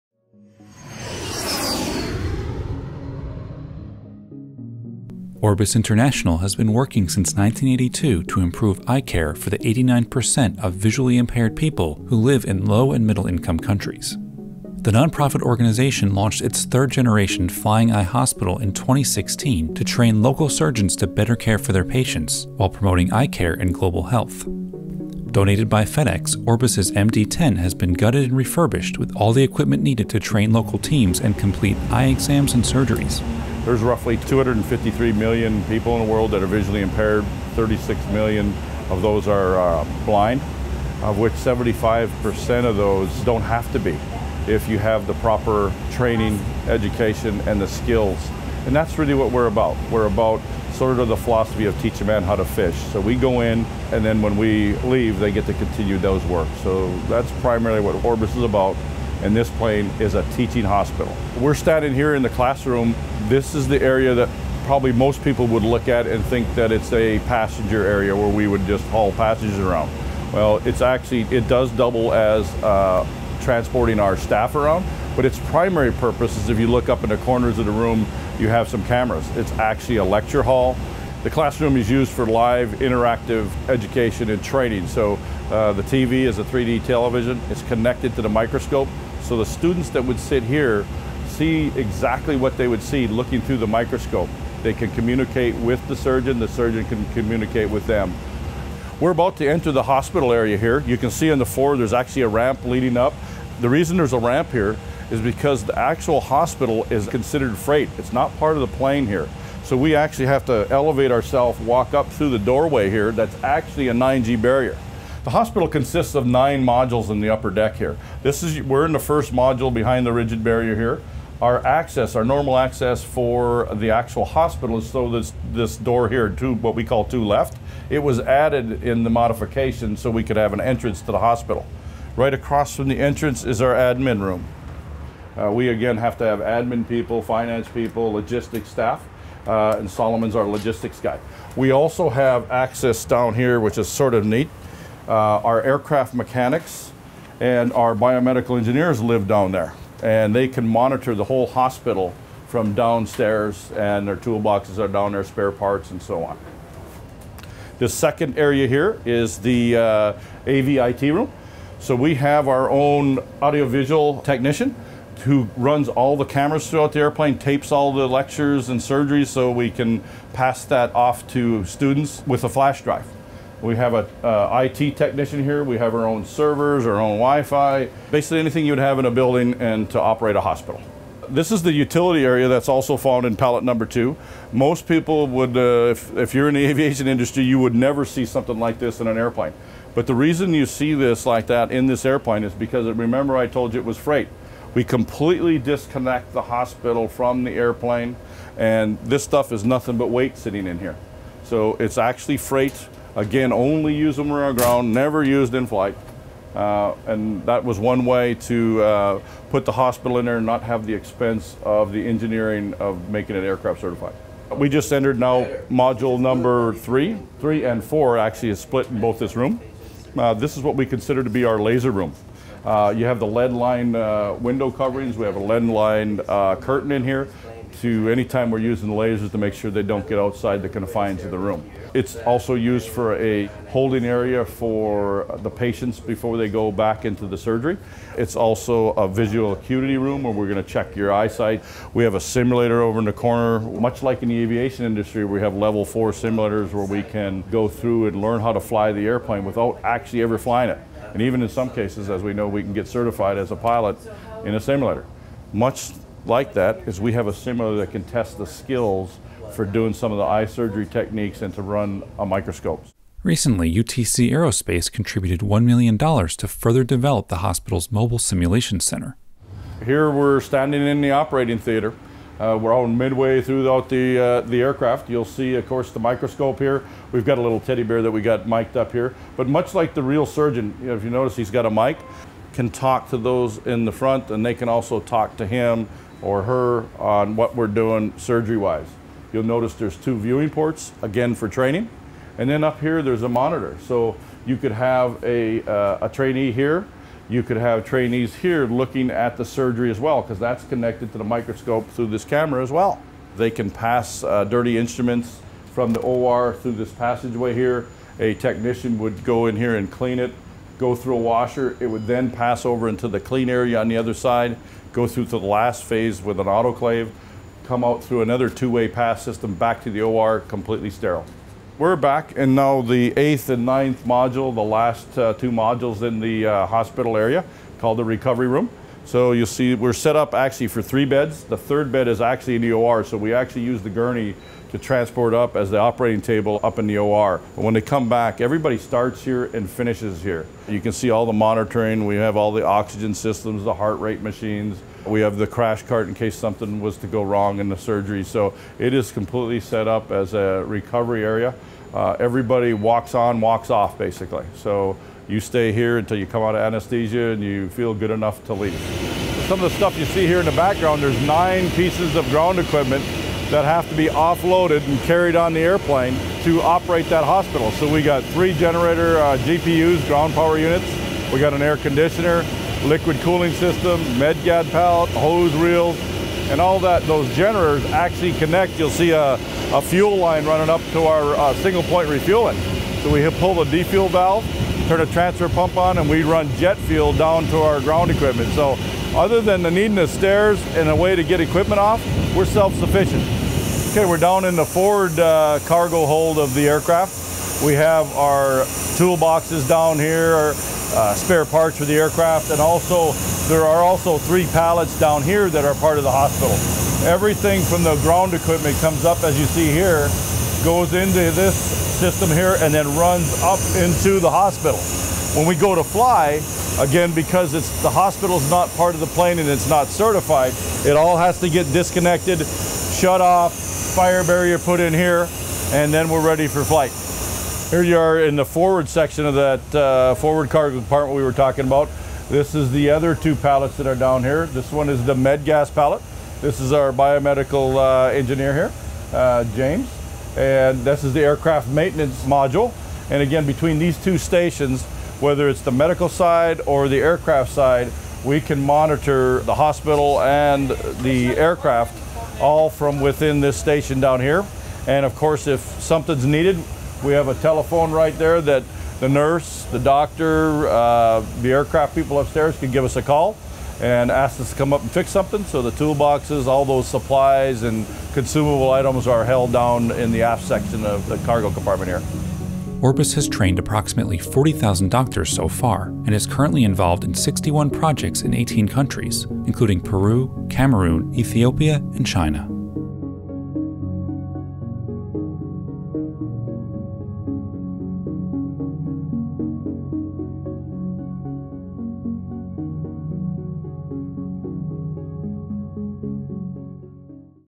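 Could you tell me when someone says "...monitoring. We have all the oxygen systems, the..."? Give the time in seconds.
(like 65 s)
341 s.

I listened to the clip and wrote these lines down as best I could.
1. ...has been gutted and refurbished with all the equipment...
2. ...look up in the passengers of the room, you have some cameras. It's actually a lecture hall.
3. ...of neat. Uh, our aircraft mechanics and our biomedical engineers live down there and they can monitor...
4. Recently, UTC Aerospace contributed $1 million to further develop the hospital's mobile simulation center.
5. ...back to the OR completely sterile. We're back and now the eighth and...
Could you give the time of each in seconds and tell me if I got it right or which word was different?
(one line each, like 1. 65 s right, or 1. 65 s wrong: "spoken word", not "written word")
1. 27 s right
2. 76 s wrong: "corners", not "passengers"
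3. 144 s right
4. 263 s right
5. 319 s right.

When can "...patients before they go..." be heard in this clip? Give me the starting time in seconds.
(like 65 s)
235 s.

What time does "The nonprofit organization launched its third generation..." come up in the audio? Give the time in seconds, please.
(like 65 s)
14 s.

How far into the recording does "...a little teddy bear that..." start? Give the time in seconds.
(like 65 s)
277 s.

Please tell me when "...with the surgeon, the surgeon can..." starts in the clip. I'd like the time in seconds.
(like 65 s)
95 s.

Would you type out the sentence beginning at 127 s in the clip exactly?
It was added in the modification so we could have an entrance to the hospital.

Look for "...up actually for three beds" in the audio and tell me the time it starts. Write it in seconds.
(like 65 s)
330 s.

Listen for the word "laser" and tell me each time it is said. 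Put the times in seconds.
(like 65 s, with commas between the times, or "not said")
221 s, 228 s.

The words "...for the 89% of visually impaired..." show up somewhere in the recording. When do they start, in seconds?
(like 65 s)
9 s.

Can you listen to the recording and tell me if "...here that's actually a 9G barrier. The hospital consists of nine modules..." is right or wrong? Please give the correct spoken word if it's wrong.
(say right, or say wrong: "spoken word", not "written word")
right.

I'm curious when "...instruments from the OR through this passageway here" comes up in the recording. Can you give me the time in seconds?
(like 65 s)
304 s.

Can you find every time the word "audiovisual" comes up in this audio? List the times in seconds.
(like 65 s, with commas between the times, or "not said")
163 s.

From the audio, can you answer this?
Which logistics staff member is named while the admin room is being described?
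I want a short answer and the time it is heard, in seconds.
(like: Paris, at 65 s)
Solomon, at 139 s.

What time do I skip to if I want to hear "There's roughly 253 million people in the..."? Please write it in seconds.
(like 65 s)
33 s.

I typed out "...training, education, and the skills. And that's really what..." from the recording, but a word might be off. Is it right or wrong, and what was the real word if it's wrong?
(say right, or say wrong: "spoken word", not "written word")
right.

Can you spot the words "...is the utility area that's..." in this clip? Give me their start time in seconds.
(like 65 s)
181 s.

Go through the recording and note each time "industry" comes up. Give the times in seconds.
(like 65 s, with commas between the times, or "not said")
187 s, 244 s.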